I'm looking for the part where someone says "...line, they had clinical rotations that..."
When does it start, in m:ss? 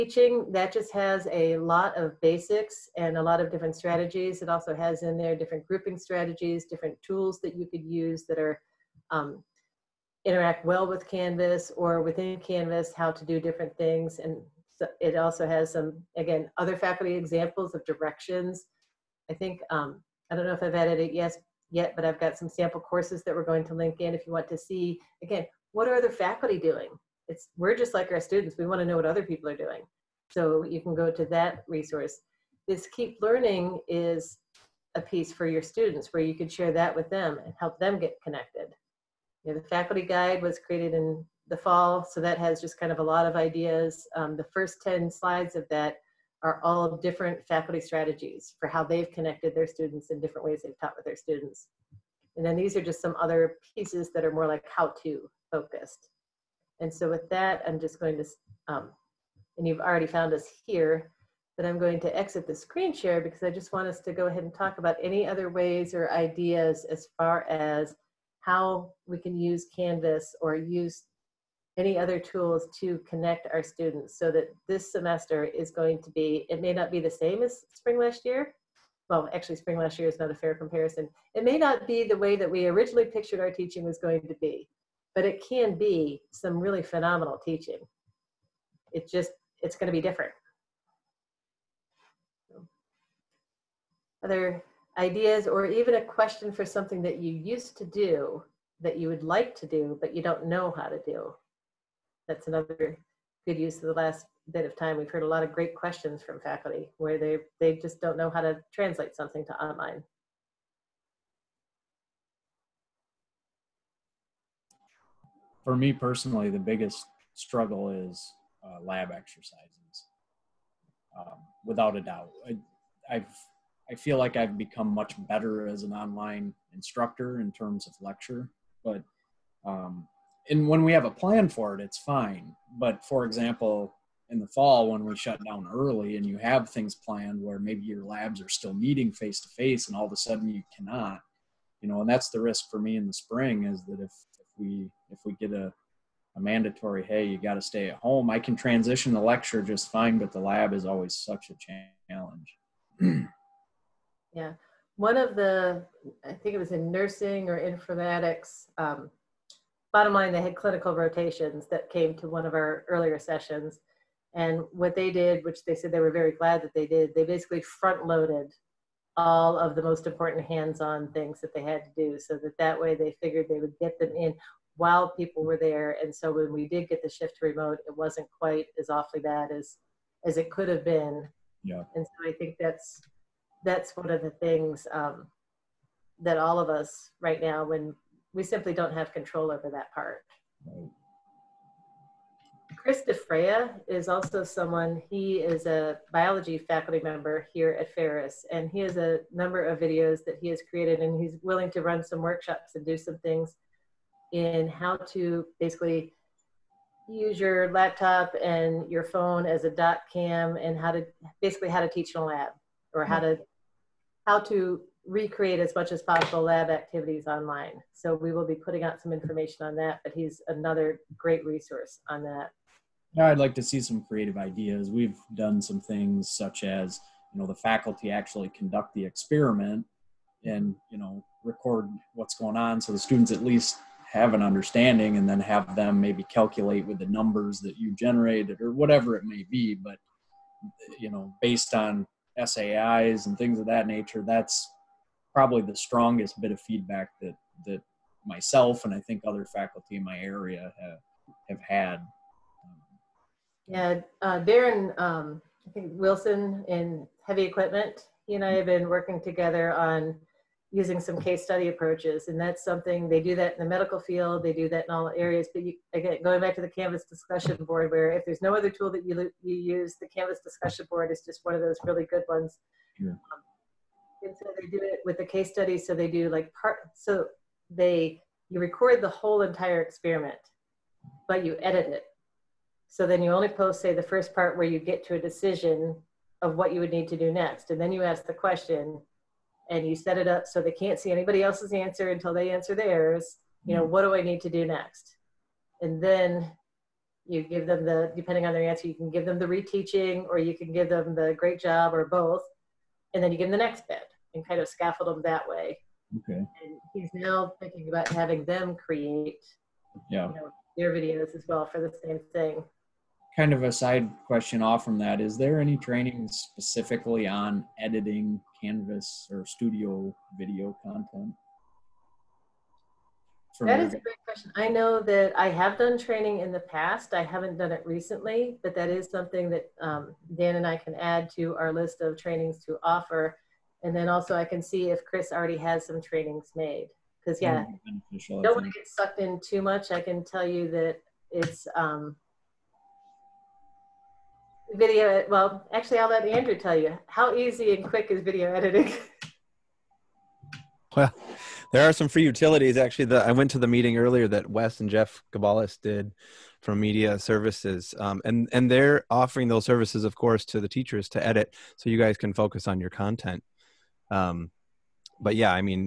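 2:40.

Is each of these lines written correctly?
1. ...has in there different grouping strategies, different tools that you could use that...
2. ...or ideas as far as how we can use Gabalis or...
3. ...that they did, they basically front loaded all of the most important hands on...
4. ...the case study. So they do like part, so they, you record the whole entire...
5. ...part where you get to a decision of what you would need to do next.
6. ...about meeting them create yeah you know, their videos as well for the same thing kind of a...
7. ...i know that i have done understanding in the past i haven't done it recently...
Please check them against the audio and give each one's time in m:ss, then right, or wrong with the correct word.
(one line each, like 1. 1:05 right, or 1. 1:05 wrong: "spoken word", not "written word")
1. 0:04 right
2. 1:05 wrong: "Canvas", not "Gabalis"
3. 2:46 right
4. 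4:35 right
5. 4:44 right
6. 5:07 wrong: "having", not "meeting"
7. 5:24 wrong: "training", not "understanding".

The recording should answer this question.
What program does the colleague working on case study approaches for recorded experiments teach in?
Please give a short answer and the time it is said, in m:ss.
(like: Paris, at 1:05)
heavy equipment, at 4:17.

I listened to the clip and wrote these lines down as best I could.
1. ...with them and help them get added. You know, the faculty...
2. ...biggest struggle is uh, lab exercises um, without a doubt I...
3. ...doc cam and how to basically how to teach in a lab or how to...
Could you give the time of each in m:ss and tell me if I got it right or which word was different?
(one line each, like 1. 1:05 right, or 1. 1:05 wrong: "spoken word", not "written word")
1. 0:36 wrong: "connected", not "added"
2. 1:56 right
3. 3:29 right.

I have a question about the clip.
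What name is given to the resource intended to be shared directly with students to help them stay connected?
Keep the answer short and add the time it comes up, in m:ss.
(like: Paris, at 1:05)
Keep Learning, at 0:32.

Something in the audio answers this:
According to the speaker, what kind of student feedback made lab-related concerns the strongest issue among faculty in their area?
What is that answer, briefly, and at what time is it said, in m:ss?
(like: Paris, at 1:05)
SAIs, at 4:02.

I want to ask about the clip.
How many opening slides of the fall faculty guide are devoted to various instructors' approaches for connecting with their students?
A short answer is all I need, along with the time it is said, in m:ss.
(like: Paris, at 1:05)
10, at 0:44.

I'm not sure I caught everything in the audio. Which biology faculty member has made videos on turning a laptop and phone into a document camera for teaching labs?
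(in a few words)
Chris DeFreya.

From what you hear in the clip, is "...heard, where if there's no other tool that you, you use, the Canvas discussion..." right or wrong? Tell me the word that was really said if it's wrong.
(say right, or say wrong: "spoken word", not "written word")
wrong: "board", not "heard".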